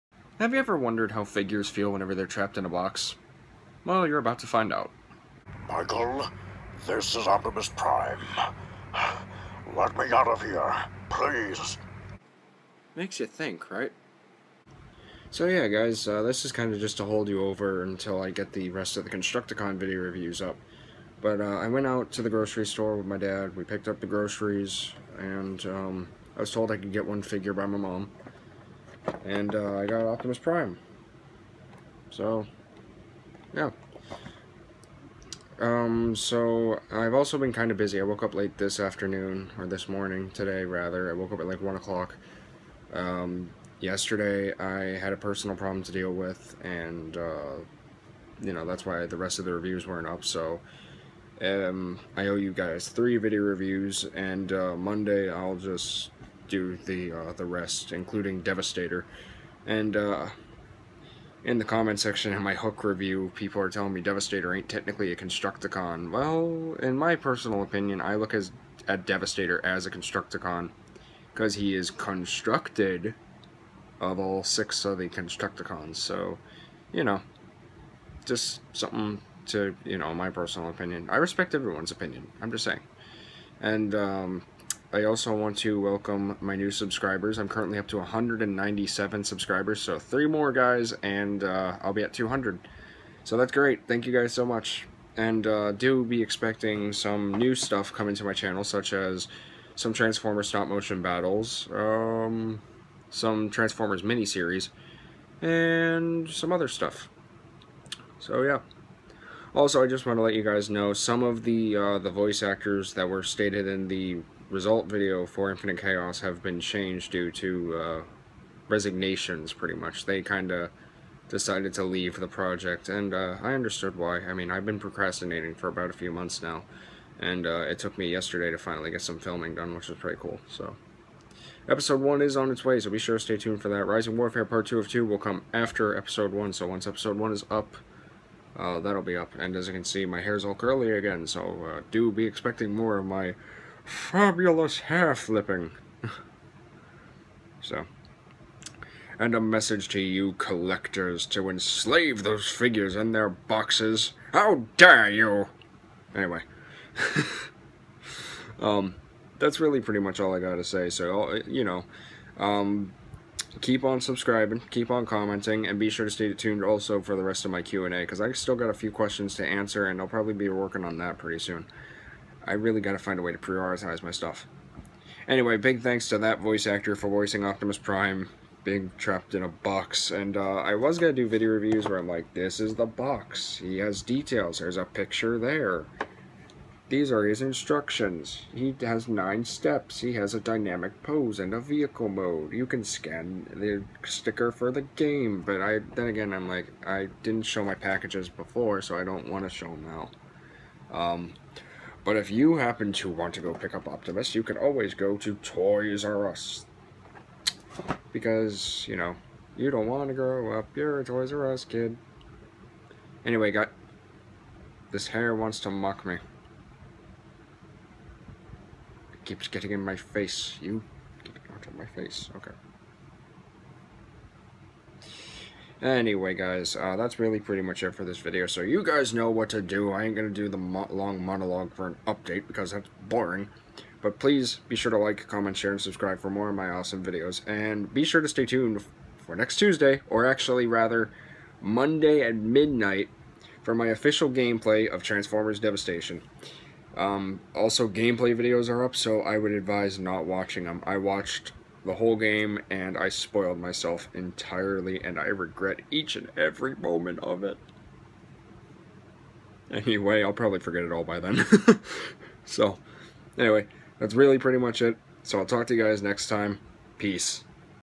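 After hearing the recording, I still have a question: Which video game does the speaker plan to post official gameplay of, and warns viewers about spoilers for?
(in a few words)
Transformers Devastation.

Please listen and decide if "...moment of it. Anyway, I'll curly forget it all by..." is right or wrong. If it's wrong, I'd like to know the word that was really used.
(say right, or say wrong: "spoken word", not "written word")
wrong: "probably", not "curly".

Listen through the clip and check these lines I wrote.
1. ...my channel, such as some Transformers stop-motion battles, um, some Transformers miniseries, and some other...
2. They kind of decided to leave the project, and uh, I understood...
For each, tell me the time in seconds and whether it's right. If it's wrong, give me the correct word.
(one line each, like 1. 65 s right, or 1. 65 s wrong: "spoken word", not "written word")
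1. 98 s right
2. 120 s right.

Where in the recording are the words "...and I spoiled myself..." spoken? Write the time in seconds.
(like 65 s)
252 s.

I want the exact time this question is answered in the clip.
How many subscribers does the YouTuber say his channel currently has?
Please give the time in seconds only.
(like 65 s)
87 s.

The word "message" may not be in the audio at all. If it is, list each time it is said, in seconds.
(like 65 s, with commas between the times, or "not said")
149 s.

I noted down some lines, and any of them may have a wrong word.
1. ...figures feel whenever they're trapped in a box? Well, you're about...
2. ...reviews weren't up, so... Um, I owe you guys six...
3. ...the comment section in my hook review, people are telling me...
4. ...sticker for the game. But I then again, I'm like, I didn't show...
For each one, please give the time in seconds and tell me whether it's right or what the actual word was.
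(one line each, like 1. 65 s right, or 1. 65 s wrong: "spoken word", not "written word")
1. 1 s right
2. 49 s wrong: "three", not "six"
3. 61 s right
4. 194 s right.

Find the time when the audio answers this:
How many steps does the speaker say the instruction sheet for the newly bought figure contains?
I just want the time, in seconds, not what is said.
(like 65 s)
189 s.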